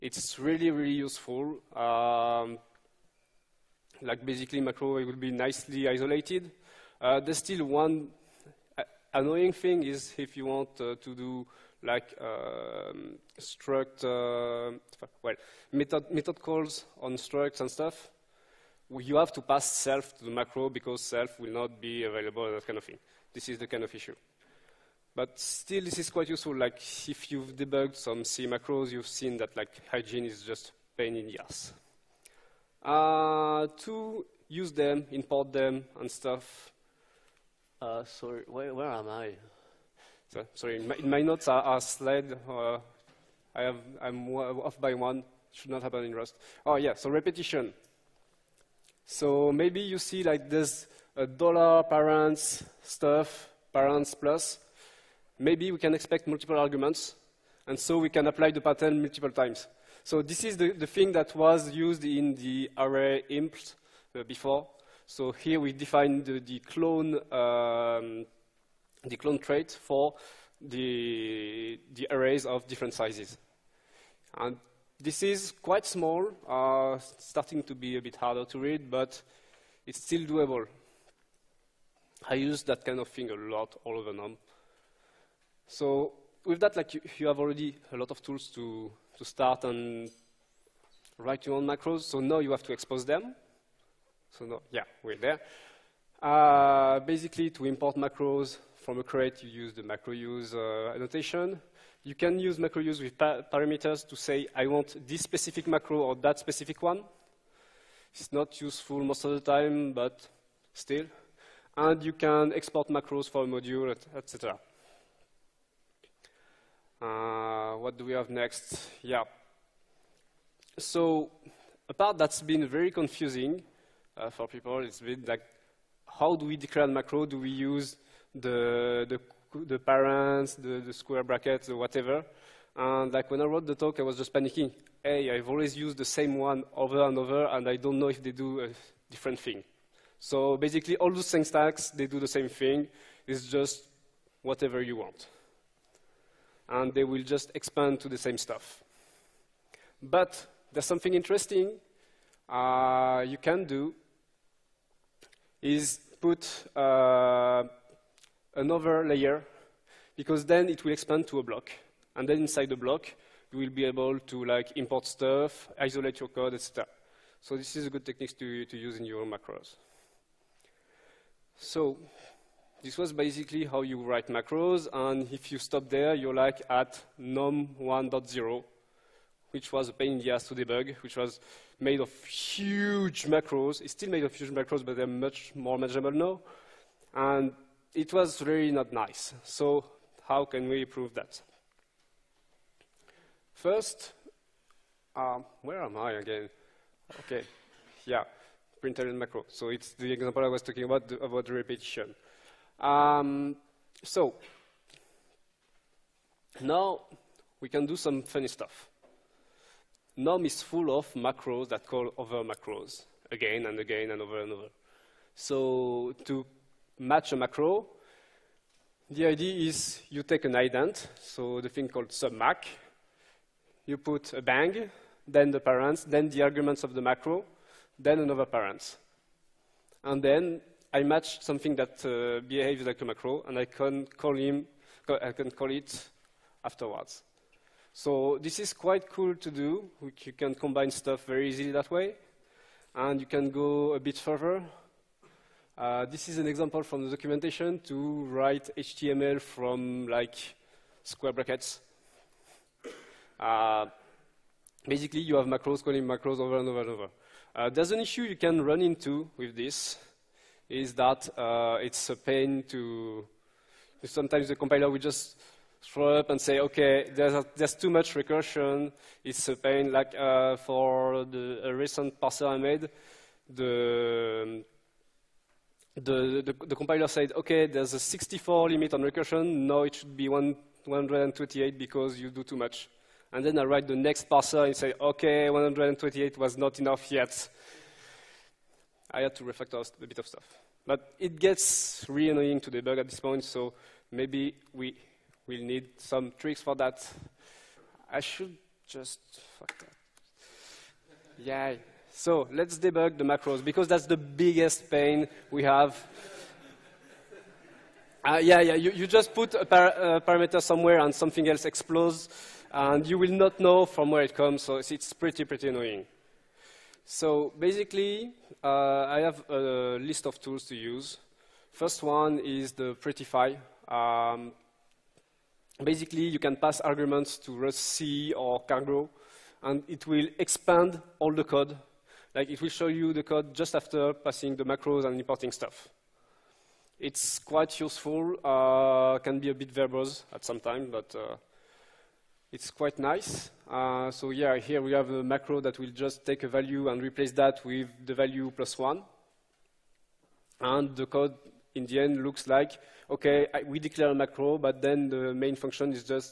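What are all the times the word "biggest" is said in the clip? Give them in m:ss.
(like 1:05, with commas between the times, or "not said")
5:04.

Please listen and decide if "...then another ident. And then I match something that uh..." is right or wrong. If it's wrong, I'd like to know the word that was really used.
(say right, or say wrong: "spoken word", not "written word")
wrong: "parent", not "ident".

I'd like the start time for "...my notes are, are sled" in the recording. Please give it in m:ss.
0:41.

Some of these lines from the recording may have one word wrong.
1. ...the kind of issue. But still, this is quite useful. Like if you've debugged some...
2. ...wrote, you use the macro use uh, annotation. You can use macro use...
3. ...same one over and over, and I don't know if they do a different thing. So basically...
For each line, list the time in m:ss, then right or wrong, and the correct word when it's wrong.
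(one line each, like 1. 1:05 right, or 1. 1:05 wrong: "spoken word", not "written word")
1. 0:23 right
2. 1:39 wrong: "crate", not "wrote"
3. 2:16 right.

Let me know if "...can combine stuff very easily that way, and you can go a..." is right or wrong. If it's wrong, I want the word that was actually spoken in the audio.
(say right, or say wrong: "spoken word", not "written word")
right.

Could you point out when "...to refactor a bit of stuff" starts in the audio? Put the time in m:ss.
4:49.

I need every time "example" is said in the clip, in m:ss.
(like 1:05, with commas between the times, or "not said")
3:20, 4:06.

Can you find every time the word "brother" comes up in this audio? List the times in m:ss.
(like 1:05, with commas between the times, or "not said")
not said.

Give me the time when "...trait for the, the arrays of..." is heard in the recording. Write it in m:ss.
1:09.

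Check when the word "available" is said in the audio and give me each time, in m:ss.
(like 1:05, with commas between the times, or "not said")
0:22.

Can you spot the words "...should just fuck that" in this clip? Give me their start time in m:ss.
4:58.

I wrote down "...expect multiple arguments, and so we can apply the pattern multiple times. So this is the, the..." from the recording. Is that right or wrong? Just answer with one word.
right.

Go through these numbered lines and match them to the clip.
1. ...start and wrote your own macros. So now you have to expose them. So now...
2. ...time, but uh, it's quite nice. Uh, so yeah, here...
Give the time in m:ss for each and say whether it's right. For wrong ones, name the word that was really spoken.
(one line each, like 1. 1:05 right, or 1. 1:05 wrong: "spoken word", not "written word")
1. 1:29 wrong: "write", not "wrote"
2. 5:40 right.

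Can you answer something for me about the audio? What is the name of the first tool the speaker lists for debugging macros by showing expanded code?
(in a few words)
Prettify.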